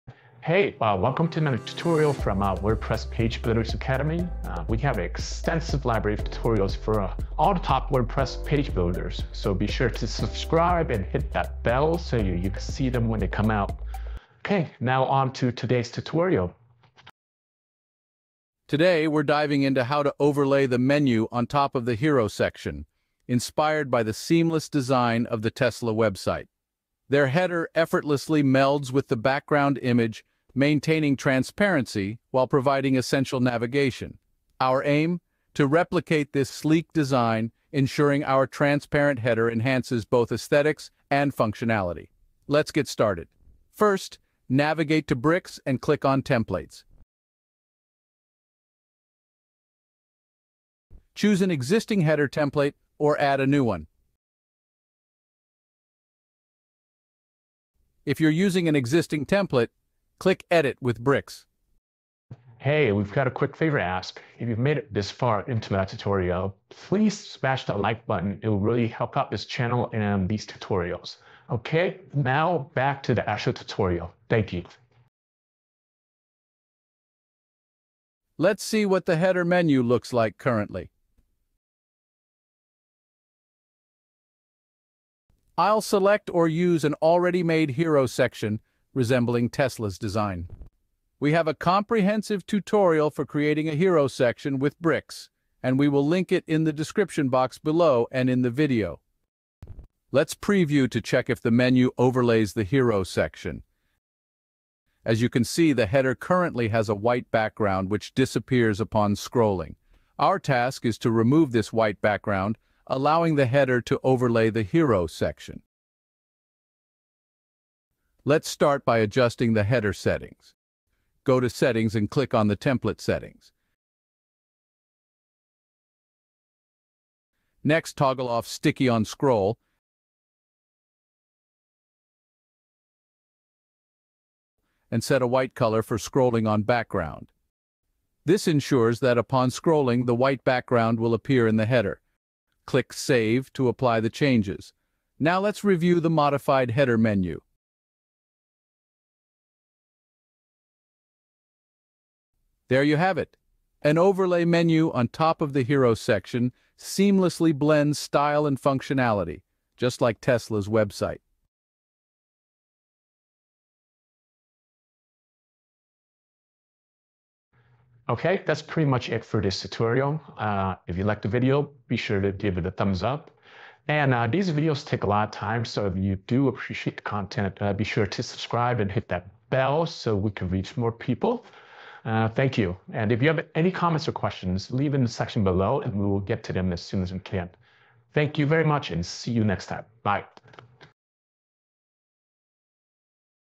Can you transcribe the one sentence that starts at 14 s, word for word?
Okay, now on to today's tutorial.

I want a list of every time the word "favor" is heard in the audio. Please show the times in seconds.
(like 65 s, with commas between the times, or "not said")
63 s.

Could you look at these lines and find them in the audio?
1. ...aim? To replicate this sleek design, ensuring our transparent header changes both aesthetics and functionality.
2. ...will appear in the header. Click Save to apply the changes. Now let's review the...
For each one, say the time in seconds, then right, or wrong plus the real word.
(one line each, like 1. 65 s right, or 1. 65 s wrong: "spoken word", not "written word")
1. 34 s wrong: "enhances", not "changes"
2. 140 s right.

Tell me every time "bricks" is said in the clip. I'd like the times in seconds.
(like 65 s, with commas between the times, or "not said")
45 s, 61 s, 94 s.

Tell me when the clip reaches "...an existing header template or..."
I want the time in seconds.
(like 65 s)
51 s.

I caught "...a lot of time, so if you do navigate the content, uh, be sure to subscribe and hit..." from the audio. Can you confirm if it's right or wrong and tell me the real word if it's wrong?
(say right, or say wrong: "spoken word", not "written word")
wrong: "appreciate", not "navigate".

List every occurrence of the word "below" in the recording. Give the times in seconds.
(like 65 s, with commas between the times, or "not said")
97 s, 185 s.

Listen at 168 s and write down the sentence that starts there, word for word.
Okay, that's pretty much it for this tutorial.